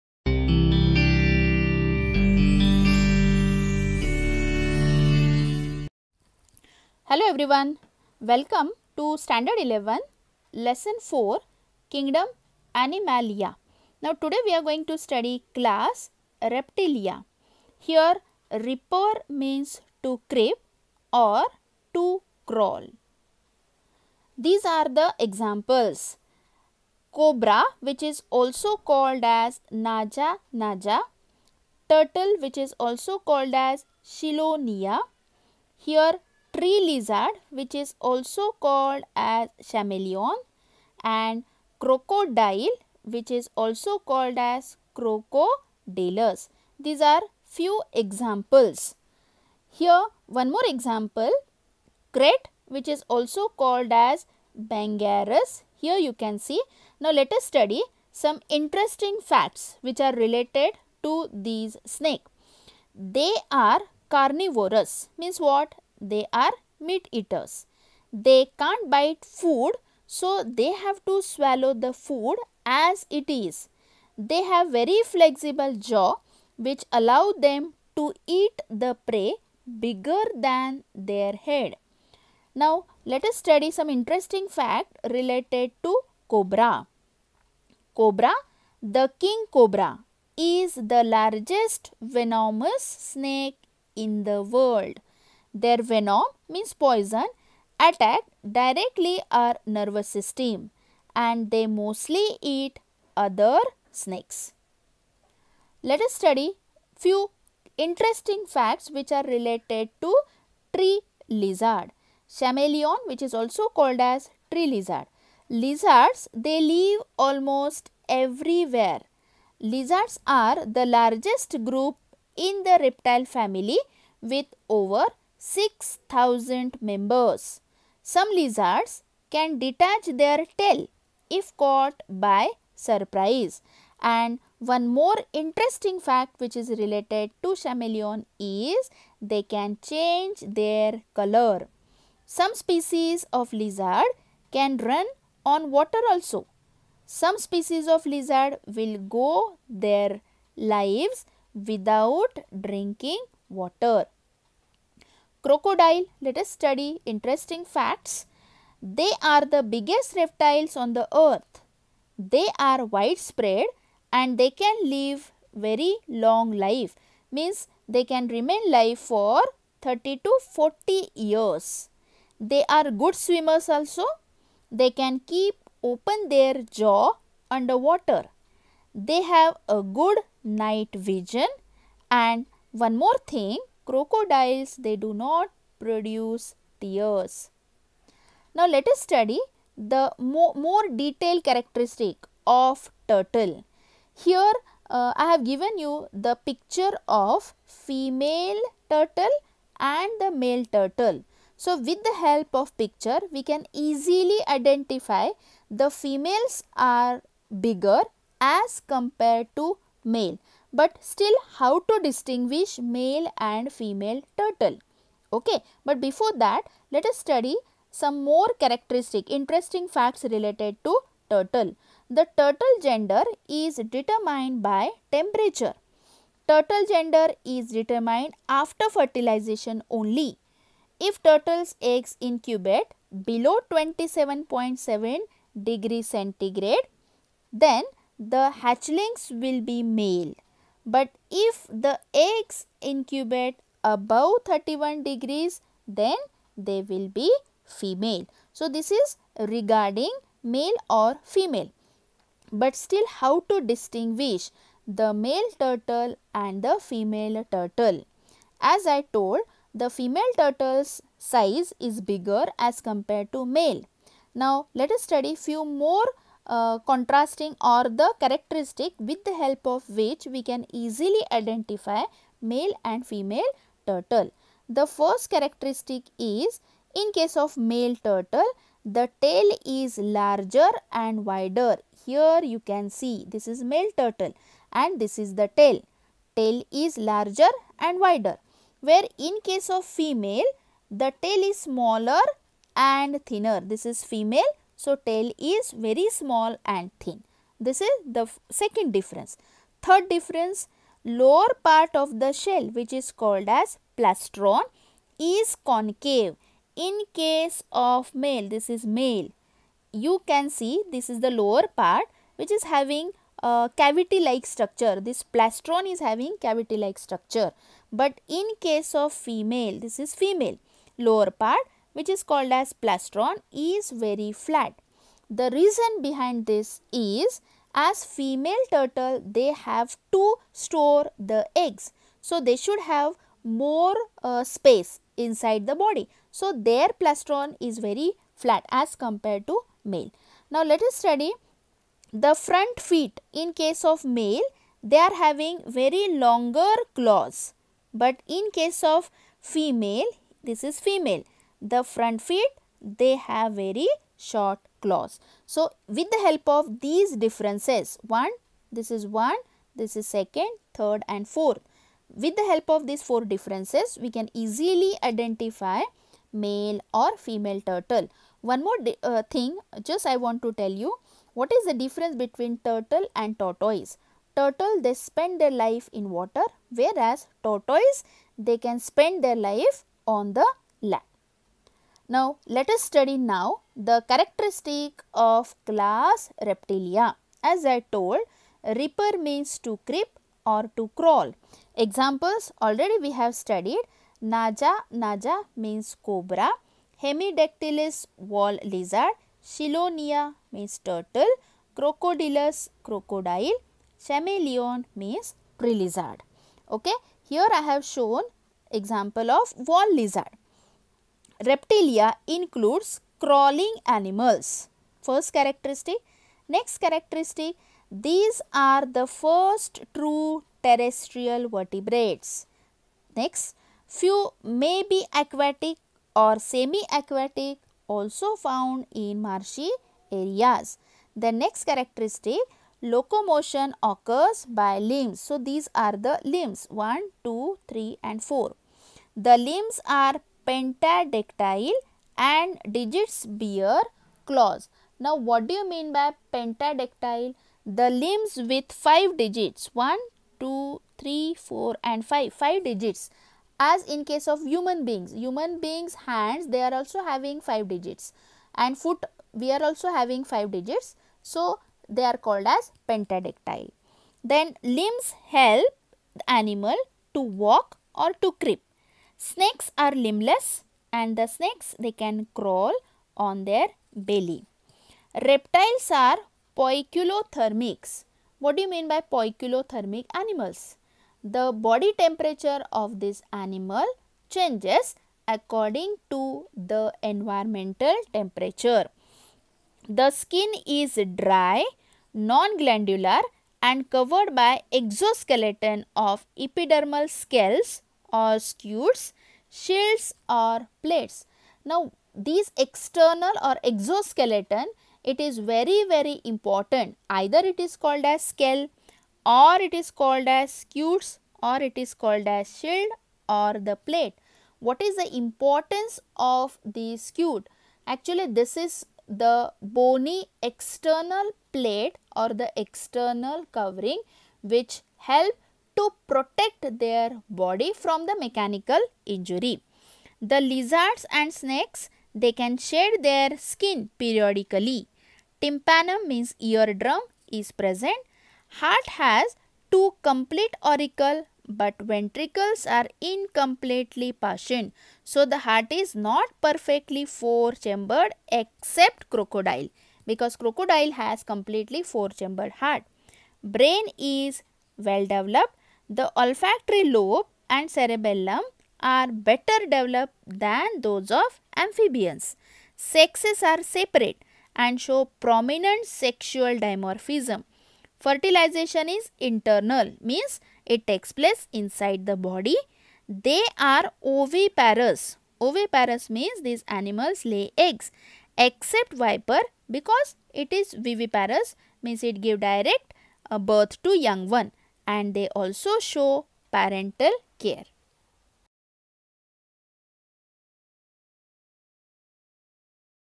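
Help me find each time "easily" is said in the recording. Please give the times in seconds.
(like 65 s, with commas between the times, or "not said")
203 s, 270 s, 364 s.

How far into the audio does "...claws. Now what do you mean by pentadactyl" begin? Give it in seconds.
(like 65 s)
444 s.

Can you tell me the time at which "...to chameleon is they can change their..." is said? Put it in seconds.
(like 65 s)
137 s.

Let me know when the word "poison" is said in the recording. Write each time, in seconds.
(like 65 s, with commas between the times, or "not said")
96 s.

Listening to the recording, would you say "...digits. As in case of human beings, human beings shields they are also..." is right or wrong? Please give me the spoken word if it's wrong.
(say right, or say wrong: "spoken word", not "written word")
wrong: "hands", not "shields".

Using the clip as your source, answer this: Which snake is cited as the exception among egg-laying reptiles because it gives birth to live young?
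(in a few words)
Viper.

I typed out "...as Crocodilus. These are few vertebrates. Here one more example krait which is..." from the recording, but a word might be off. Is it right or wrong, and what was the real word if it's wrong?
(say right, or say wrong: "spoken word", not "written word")
wrong: "examples", not "vertebrates".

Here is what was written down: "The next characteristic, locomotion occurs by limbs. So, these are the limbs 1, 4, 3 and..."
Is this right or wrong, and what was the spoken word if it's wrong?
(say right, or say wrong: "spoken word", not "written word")
wrong: "2", not "4".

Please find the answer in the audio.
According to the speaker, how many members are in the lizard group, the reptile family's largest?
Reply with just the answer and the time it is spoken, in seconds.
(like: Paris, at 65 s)
over 6,000, at 124 s.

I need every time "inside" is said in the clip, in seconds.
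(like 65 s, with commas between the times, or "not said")
335 s, 571 s.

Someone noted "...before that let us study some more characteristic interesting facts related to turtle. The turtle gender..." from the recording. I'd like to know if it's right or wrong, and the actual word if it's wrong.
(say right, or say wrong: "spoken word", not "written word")
right.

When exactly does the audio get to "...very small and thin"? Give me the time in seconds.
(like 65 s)
295 s.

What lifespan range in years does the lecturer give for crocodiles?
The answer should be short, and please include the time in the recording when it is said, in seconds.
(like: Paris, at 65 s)
30 to 40 years, at 169 s.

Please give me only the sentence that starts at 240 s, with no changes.
But if the eggs incubate above 31 degrees, then they will be female.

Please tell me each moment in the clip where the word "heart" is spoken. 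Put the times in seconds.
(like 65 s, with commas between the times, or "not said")
538 s, 545 s, 552 s.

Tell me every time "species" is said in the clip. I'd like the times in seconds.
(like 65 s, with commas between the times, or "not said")
142 s, 147 s.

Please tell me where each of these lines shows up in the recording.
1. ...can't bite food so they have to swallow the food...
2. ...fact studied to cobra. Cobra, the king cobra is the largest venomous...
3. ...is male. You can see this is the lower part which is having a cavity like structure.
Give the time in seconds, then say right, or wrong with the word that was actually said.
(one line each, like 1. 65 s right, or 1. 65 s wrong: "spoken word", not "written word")
1. 68 s right
2. 84 s wrong: "related", not "studied"
3. 308 s right.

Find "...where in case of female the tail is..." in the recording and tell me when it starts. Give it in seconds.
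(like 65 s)
288 s.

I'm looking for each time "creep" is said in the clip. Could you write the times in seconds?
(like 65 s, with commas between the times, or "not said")
20 s, 389 s, 468 s.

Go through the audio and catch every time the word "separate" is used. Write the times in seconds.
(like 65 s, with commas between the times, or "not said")
563 s.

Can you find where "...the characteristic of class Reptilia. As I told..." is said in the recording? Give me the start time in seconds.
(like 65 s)
383 s.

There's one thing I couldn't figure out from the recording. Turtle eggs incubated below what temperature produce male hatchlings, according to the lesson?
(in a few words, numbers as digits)
27.7 degrees centigrade.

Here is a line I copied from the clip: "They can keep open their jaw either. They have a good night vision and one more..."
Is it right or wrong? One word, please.
wrong.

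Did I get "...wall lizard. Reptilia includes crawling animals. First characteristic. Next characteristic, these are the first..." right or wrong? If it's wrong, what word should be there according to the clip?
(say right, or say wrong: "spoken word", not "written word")
right.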